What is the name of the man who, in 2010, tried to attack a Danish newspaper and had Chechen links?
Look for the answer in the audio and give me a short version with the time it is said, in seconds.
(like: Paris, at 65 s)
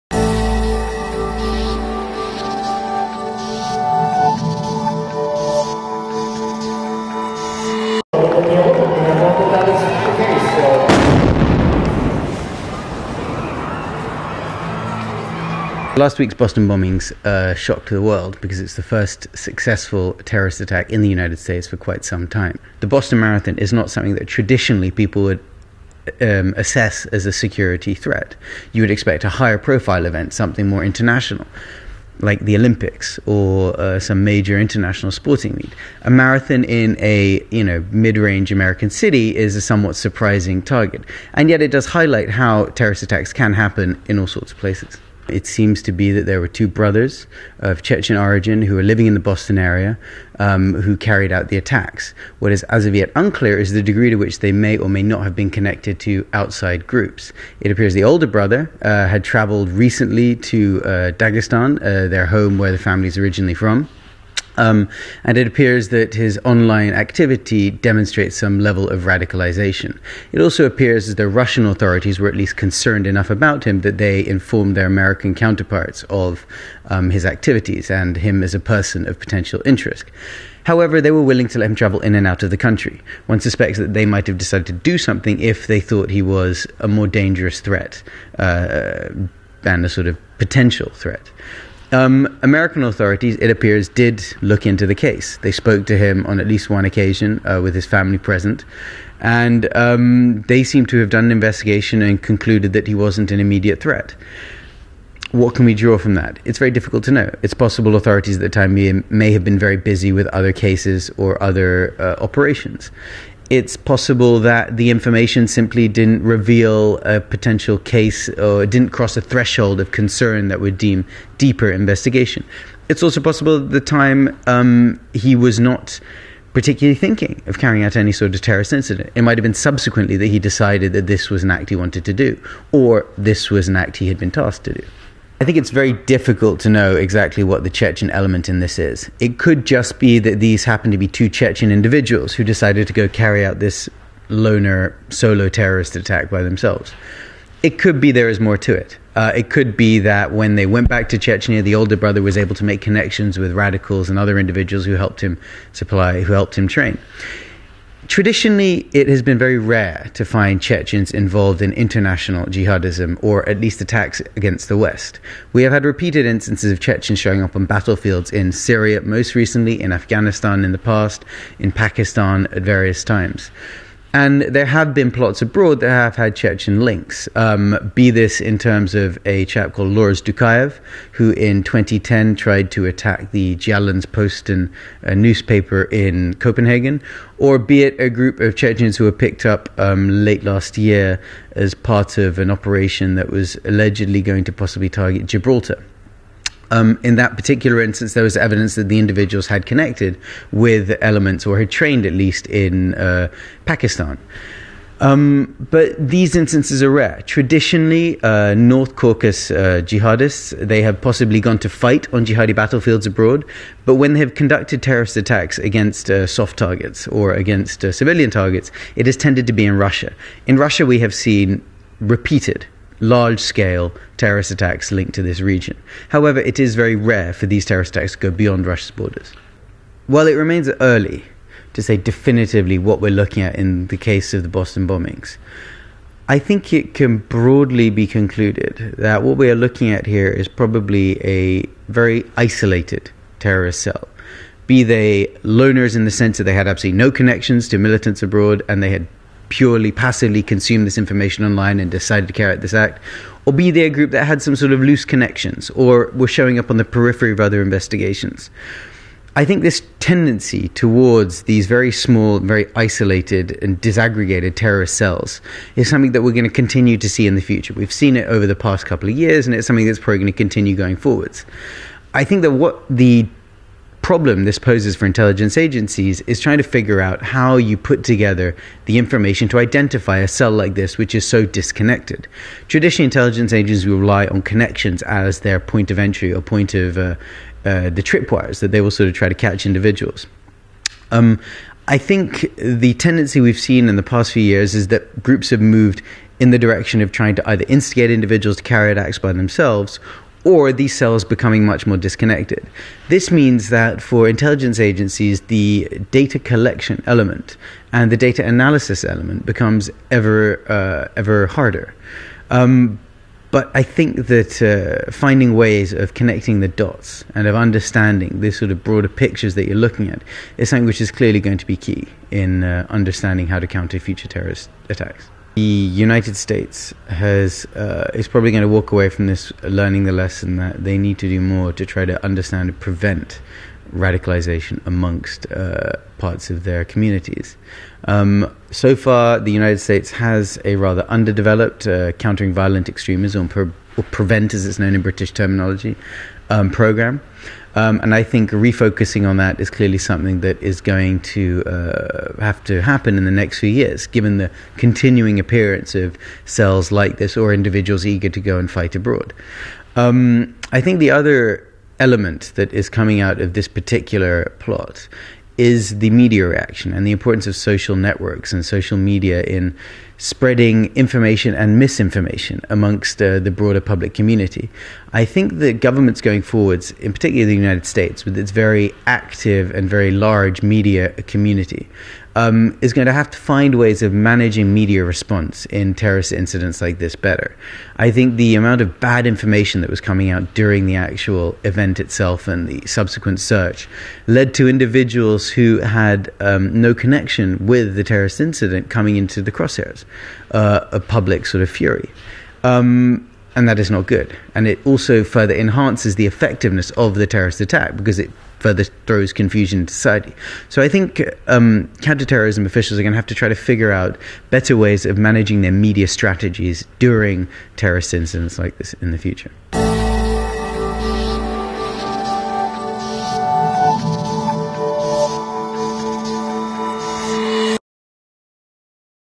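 Loris Dukayev, at 179 s.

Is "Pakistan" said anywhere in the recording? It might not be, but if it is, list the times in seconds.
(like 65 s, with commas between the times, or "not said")
171 s, 203 s.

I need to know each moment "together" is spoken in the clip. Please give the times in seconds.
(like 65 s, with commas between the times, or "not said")
278 s.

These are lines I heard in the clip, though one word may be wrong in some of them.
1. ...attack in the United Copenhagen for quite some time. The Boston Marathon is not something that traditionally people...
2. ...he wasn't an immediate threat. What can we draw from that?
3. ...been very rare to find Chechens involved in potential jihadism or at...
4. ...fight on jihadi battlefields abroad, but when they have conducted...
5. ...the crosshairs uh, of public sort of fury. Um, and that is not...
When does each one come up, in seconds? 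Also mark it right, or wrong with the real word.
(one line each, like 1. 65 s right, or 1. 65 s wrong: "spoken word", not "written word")
1. 20 s wrong: "States", not "Copenhagen"
2. 102 s right
3. 159 s wrong: "international", not "potential"
4. 211 s right
5. 399 s right.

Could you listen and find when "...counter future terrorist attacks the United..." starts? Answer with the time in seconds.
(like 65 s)
323 s.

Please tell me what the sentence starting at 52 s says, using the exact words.
What is as of yet unclear is the degree to which they may or may not have been connected to outside groups.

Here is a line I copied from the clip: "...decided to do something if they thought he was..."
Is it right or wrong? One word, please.
right.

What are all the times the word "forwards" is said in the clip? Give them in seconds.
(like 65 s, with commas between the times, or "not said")
270 s, 376 s.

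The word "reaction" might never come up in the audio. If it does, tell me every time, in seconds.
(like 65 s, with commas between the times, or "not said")
366 s.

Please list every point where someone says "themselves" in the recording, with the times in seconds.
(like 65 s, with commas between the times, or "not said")
146 s, 299 s.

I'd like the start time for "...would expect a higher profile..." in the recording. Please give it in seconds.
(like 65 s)
28 s.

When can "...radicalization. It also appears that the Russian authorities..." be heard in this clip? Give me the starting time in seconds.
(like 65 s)
69 s.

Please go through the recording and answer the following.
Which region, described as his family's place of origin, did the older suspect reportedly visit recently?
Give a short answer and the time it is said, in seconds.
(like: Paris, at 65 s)
Dagestan, at 61 s.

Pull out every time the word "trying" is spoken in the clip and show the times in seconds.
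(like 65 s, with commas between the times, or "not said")
276 s, 297 s.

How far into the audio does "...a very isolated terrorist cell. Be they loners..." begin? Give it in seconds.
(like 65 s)
241 s.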